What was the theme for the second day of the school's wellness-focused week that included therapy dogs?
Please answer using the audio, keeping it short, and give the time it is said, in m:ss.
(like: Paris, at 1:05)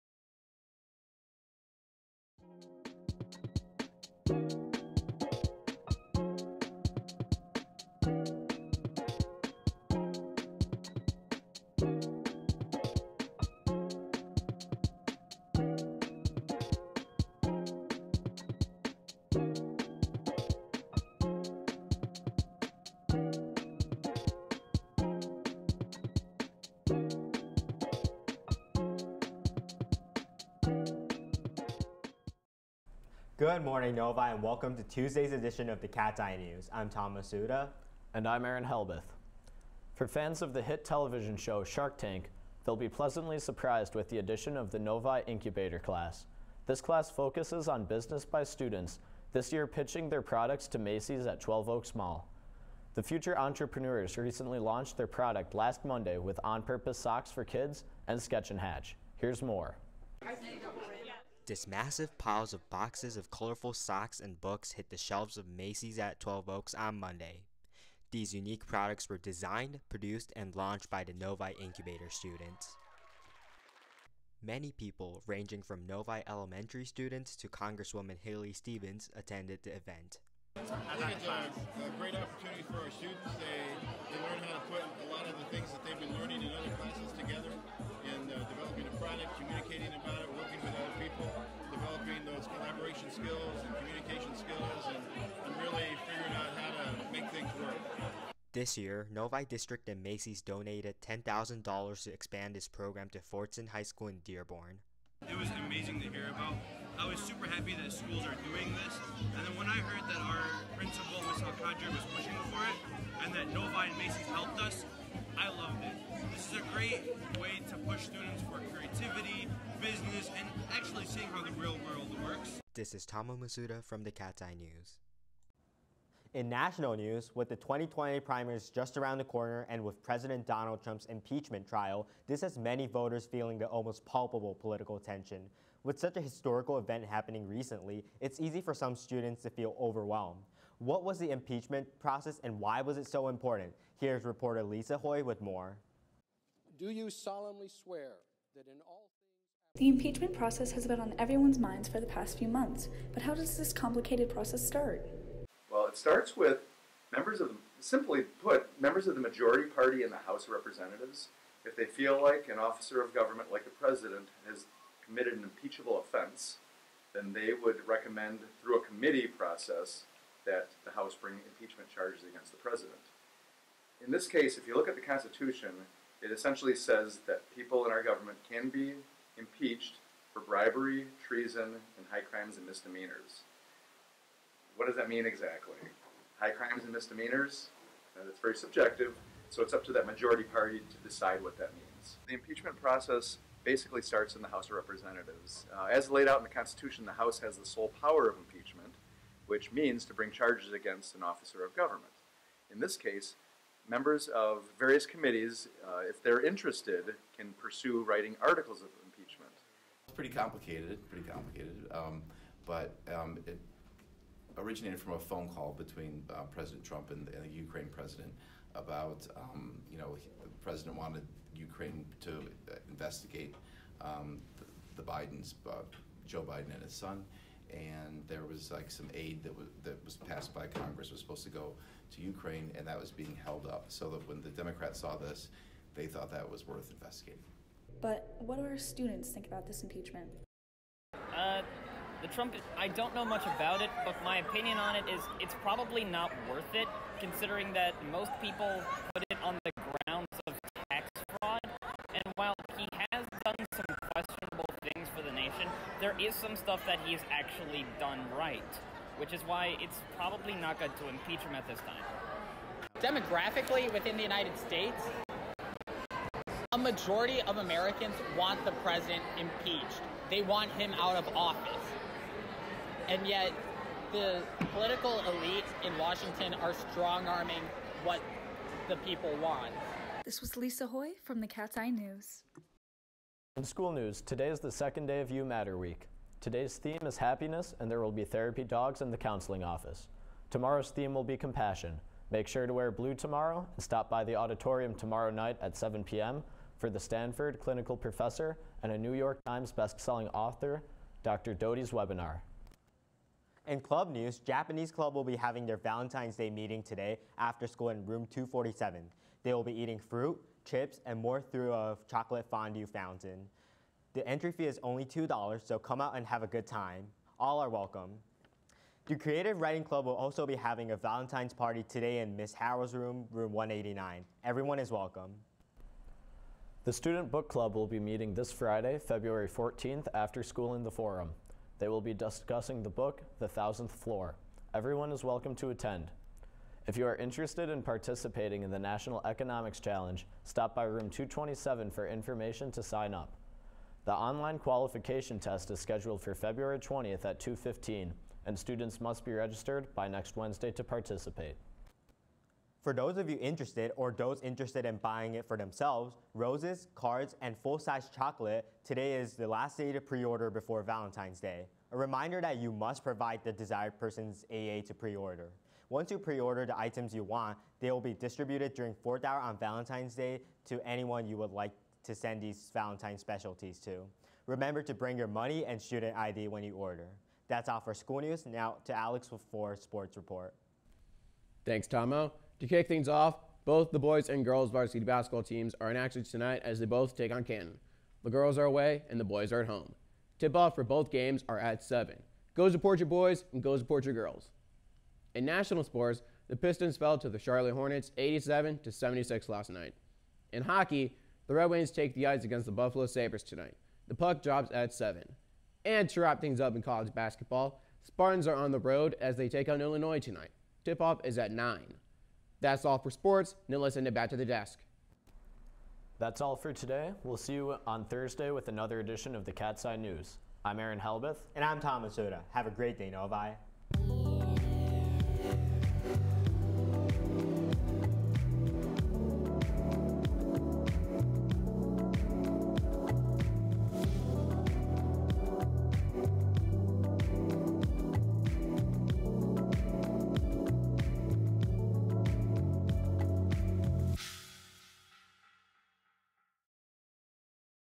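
happiness, at 4:47.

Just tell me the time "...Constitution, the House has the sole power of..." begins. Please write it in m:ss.
3:16.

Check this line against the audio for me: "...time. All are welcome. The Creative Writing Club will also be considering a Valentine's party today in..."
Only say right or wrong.
wrong.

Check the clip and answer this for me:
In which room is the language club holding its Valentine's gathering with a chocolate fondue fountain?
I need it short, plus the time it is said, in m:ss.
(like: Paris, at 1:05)
247, at 5:08.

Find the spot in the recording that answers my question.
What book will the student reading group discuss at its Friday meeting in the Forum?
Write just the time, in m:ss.
5:33.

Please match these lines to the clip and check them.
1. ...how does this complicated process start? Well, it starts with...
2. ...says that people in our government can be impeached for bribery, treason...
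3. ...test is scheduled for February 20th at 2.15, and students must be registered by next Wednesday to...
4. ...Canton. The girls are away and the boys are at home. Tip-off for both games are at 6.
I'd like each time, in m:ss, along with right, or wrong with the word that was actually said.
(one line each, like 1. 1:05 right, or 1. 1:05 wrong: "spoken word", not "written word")
1. 2:33 right
2. 2:56 right
3. 5:45 right
4. 6:27 wrong: "7", not "6".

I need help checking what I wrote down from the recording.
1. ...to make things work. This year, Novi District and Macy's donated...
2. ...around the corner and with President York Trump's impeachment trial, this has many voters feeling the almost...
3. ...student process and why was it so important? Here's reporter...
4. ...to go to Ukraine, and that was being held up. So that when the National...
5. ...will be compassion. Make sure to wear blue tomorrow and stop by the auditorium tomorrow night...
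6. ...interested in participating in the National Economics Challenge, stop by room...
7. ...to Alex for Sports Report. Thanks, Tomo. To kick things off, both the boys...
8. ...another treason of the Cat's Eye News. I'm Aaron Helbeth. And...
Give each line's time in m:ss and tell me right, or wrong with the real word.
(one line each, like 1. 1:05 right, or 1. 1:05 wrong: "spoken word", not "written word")
1. 1:36 right
2. 2:08 wrong: "Donald", not "York"
3. 2:21 wrong: "impeachment", not "student"
4. 3:51 wrong: "Democrats", not "National"
5. 4:51 right
6. 5:37 right
7. 6:18 right
8. 6:58 wrong: "edition", not "treason".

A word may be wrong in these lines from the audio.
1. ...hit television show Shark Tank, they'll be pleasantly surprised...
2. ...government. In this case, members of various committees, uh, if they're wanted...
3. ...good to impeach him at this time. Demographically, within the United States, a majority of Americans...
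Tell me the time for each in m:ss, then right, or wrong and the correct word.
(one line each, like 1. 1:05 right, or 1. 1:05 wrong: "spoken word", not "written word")
1. 0:40 right
2. 3:21 wrong: "interested", not "wanted"
3. 4:20 right.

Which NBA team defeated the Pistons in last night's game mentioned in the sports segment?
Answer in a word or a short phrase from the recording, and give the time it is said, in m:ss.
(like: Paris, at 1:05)
Charlotte Hornets, at 6:37.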